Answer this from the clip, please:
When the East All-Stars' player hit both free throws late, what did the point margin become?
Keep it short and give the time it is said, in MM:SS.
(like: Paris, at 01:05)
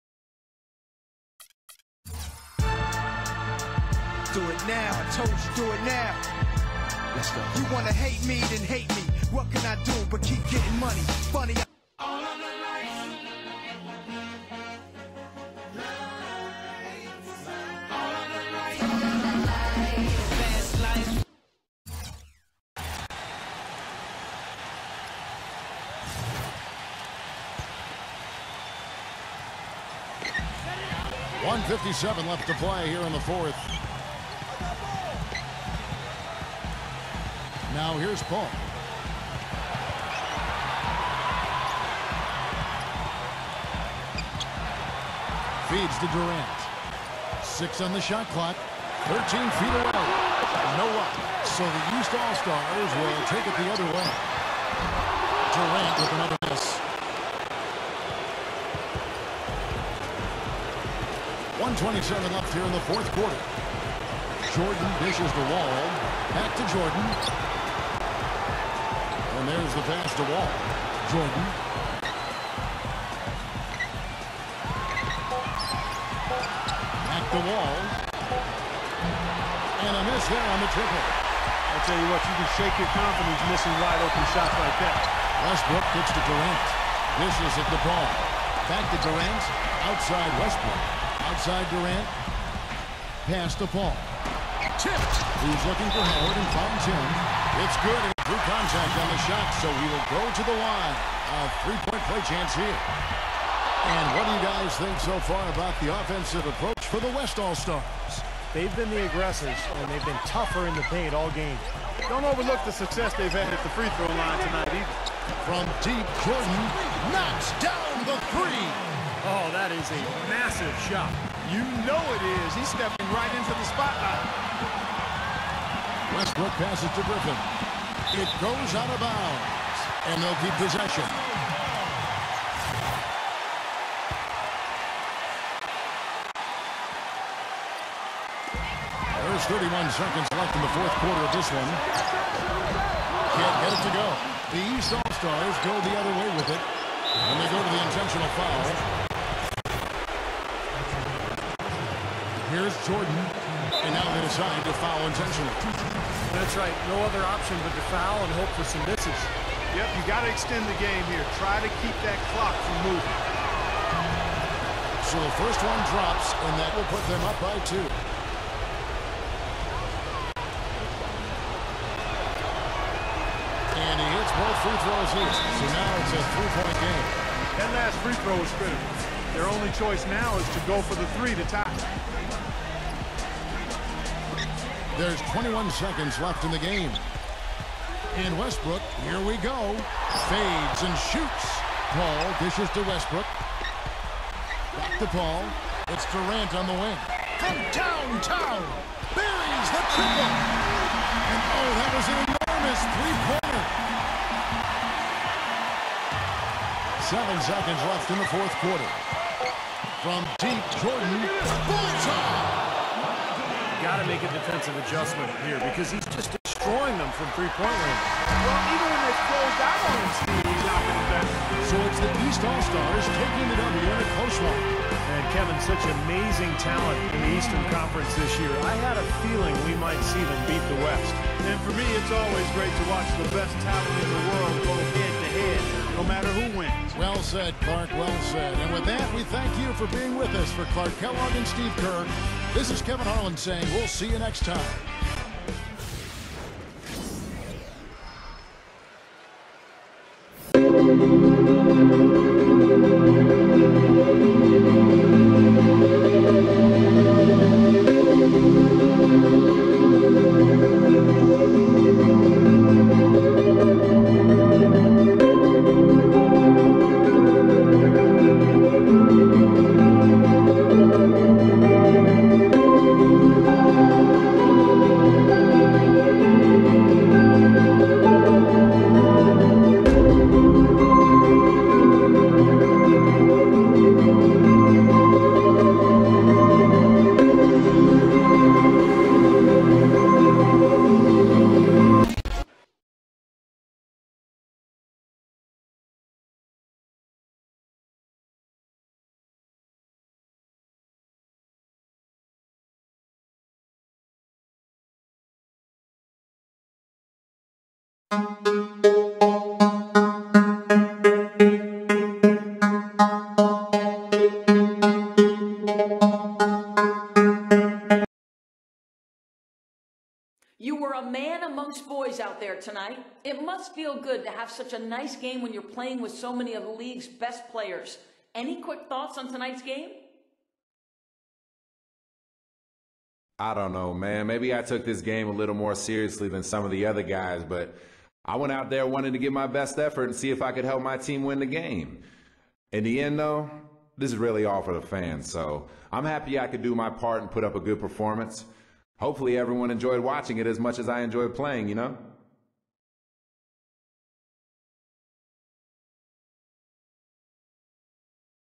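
3, at 02:56.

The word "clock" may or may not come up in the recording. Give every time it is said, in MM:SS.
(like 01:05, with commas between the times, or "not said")
00:48, 02:42.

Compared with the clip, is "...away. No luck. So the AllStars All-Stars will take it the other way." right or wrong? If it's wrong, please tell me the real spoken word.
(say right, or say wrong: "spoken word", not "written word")
wrong: "East", not "AllStars".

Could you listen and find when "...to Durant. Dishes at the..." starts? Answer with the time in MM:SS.
01:26.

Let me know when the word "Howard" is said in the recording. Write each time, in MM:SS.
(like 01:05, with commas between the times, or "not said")
01:36.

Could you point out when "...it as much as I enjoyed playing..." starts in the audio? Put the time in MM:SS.
05:50.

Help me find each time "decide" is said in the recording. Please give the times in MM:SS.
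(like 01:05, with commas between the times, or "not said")
02:34.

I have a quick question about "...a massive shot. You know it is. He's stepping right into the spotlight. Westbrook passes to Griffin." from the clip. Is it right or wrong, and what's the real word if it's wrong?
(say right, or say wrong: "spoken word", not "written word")
right.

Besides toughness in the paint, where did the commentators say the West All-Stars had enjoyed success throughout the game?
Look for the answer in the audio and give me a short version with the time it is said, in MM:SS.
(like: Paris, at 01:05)
The free throw line, at 01:53.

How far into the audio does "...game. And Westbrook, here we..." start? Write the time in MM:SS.
03:06.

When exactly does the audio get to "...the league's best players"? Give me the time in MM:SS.
05:26.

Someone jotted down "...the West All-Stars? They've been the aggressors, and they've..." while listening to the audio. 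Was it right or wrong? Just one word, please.
right.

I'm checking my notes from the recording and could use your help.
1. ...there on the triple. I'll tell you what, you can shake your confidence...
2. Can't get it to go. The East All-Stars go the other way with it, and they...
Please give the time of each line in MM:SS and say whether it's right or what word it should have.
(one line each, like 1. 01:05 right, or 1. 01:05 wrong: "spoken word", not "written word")
1. 01:20 right
2. 02:21 right.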